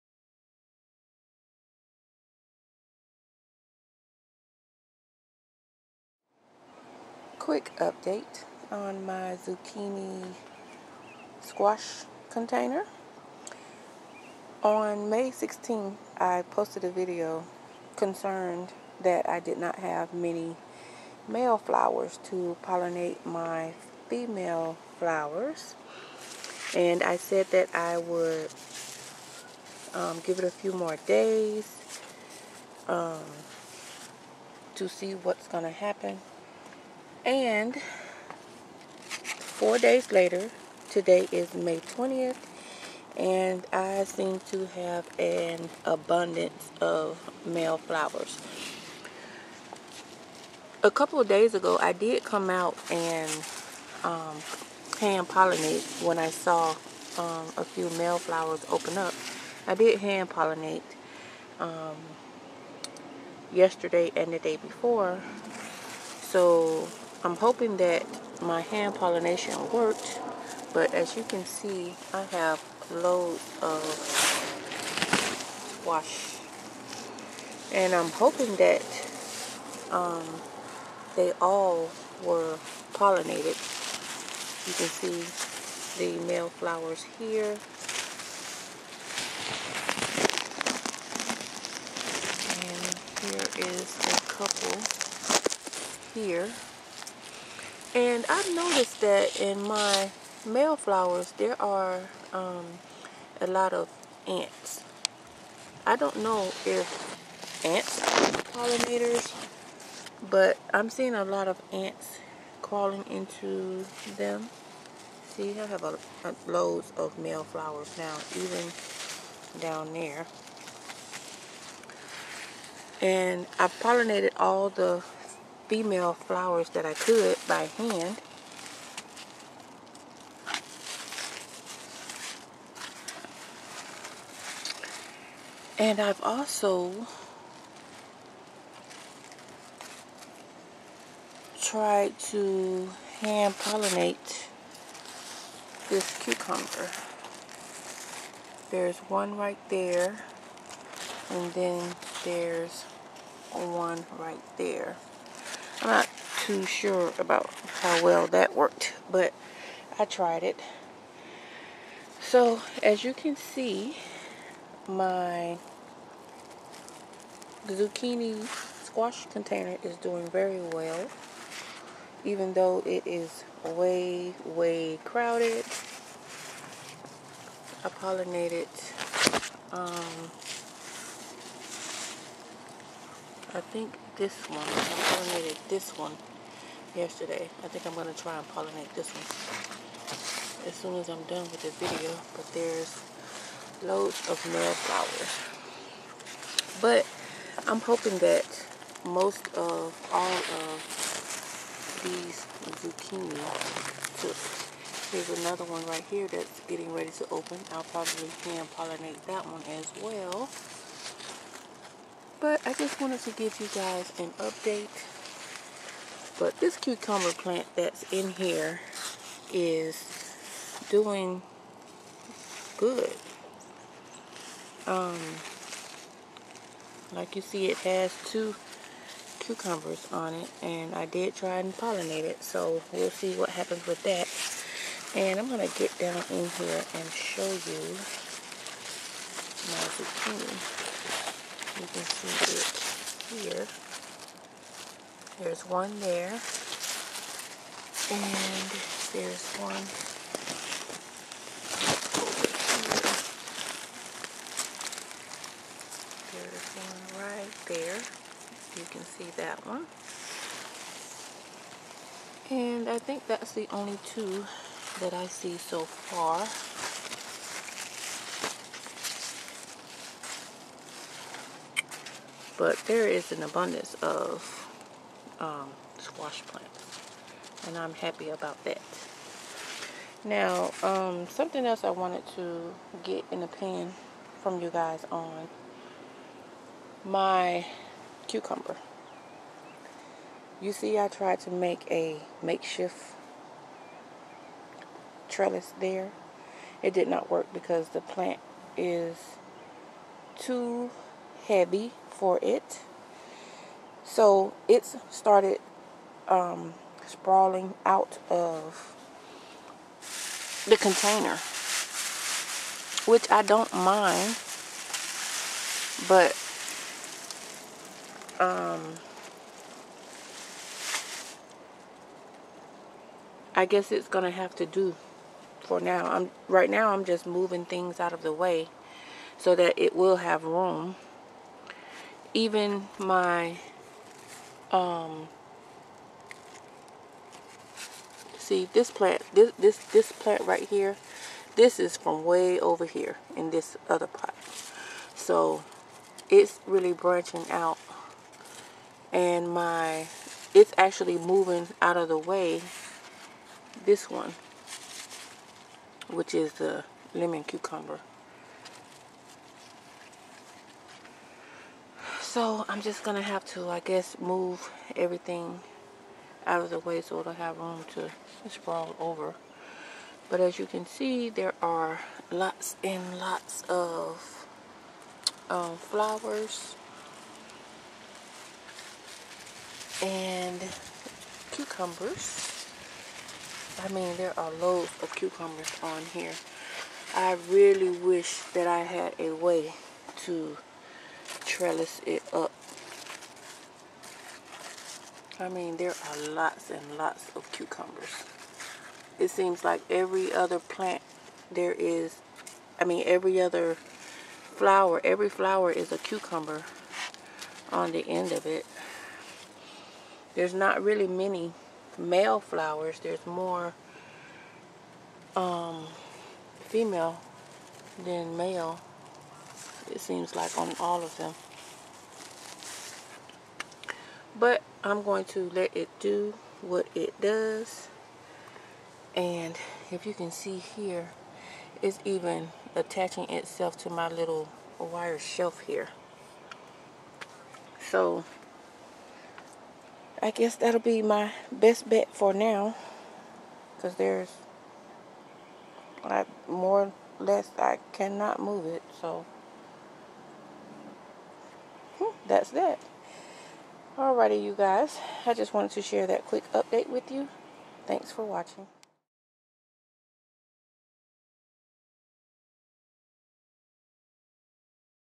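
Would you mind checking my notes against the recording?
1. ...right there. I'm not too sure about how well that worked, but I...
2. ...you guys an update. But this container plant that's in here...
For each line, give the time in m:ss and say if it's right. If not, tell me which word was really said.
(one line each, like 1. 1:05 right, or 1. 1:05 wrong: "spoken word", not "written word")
1. 2:34 right
2. 3:33 wrong: "cucumber", not "container".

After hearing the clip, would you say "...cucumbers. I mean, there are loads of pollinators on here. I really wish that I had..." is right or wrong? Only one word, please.
wrong.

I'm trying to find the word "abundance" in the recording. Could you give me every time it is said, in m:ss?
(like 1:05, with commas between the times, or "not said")
0:45, 4:33.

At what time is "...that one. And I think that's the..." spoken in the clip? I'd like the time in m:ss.
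4:19.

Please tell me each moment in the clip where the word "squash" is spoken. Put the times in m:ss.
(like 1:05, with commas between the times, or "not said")
0:11, 1:15, 2:48, 4:35.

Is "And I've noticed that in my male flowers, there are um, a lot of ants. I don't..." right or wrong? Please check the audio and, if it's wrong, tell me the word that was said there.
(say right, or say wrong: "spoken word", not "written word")
right.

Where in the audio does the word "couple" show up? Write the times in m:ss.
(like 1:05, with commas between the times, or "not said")
0:50, 1:35.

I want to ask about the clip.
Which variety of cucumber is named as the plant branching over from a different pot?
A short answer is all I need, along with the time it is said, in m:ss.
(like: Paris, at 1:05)
Lemon cucumber, at 5:57.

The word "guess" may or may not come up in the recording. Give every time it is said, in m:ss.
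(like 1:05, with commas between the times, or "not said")
5:23, 6:03, 7:20.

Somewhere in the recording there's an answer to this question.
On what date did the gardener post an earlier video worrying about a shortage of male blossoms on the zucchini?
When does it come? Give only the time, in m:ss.
0:15.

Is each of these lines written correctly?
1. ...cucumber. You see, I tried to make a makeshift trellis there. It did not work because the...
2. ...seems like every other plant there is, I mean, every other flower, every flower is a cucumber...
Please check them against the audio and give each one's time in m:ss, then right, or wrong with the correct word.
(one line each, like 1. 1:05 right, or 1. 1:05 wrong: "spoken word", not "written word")
1. 4:48 right
2. 6:39 right.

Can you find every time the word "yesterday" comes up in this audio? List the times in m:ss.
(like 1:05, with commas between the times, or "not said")
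1:03, 3:06.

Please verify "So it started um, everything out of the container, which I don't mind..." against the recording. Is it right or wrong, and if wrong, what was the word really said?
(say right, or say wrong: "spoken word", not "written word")
wrong: "sprawling", not "everything".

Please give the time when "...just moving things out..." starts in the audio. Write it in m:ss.
5:27.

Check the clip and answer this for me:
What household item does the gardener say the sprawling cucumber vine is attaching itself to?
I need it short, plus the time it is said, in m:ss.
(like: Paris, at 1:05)
Wire shelf, at 7:14.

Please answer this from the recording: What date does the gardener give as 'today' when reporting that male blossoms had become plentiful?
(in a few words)
May 20th.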